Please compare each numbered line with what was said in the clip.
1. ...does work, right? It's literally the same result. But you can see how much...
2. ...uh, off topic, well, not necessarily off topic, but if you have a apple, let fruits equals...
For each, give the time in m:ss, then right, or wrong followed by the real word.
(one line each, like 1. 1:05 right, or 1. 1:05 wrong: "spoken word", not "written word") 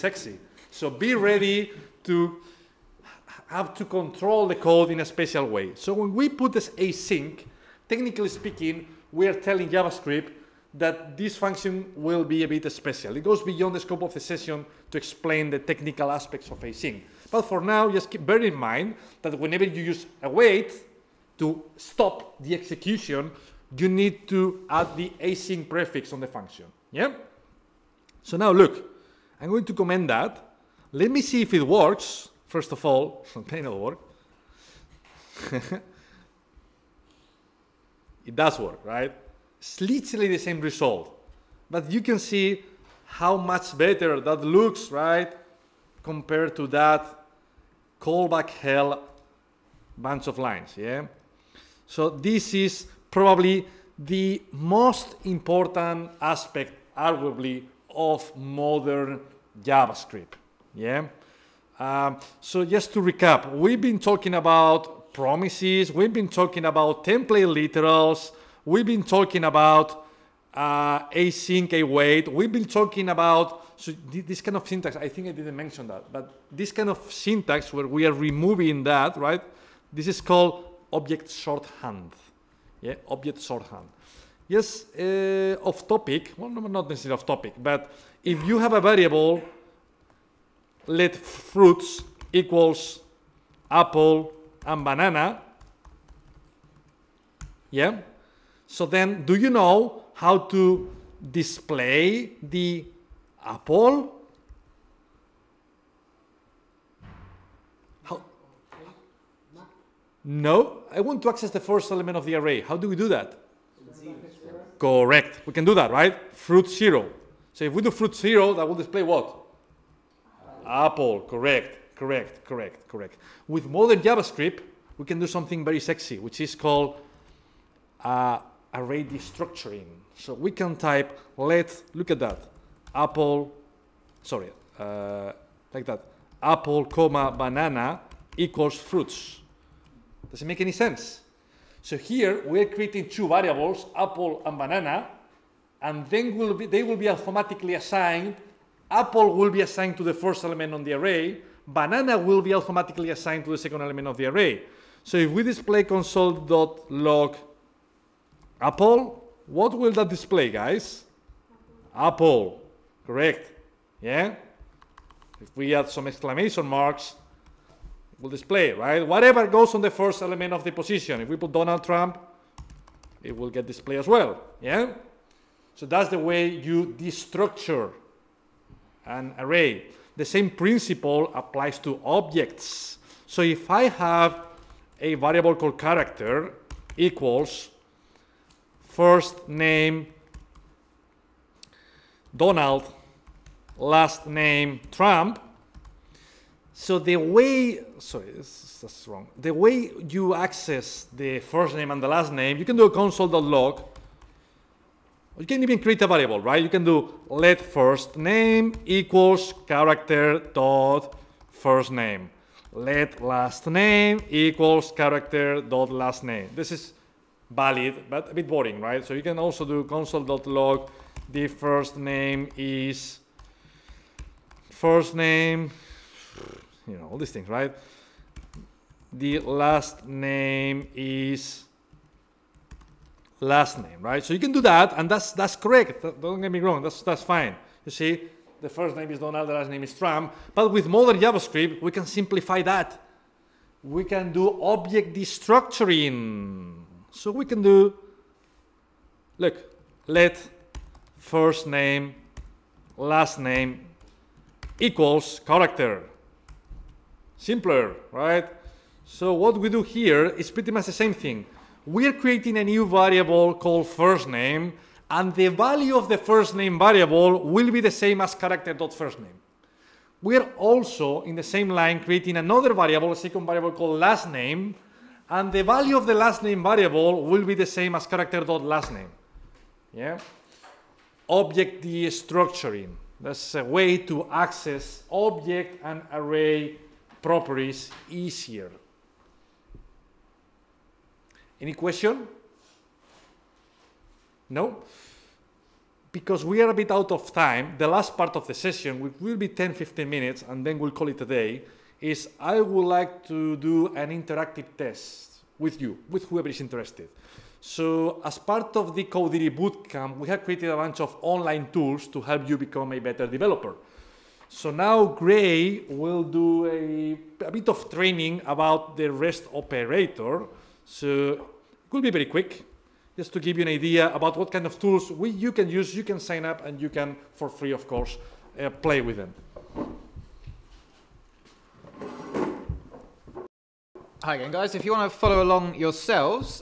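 1. 0:38 right
2. 1:24 wrong: "variable", not "apple".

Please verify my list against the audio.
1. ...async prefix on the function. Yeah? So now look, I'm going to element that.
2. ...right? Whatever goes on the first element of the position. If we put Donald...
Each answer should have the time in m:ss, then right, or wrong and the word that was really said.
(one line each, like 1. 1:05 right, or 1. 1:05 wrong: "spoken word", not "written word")
1. 0:25 wrong: "comment", not "element"
2. 2:48 right.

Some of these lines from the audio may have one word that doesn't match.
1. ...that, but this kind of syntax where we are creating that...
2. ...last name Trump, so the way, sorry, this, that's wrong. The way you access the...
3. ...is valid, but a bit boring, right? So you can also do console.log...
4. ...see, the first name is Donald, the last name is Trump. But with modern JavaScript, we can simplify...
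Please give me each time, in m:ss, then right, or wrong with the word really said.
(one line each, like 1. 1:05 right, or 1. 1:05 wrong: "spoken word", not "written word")
1. 1:15 wrong: "removing", not "creating"
2. 3:13 right
3. 3:36 right
4. 3:57 right.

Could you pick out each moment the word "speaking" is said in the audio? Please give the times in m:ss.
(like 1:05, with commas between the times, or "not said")
0:08.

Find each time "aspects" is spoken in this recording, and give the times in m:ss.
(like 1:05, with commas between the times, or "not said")
0:16, 0:56.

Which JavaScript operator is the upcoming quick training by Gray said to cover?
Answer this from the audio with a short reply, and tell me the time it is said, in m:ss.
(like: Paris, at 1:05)
REST operator, at 5:19.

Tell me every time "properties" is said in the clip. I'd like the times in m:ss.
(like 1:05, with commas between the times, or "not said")
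4:47.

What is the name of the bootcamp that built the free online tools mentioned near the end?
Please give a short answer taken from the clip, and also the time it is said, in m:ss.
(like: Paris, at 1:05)
Kodiri Bootcamp, at 5:09.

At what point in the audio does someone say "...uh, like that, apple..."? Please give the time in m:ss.
2:14.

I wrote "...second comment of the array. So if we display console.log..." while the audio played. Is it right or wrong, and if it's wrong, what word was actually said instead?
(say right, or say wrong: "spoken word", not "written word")
wrong: "element", not "comment".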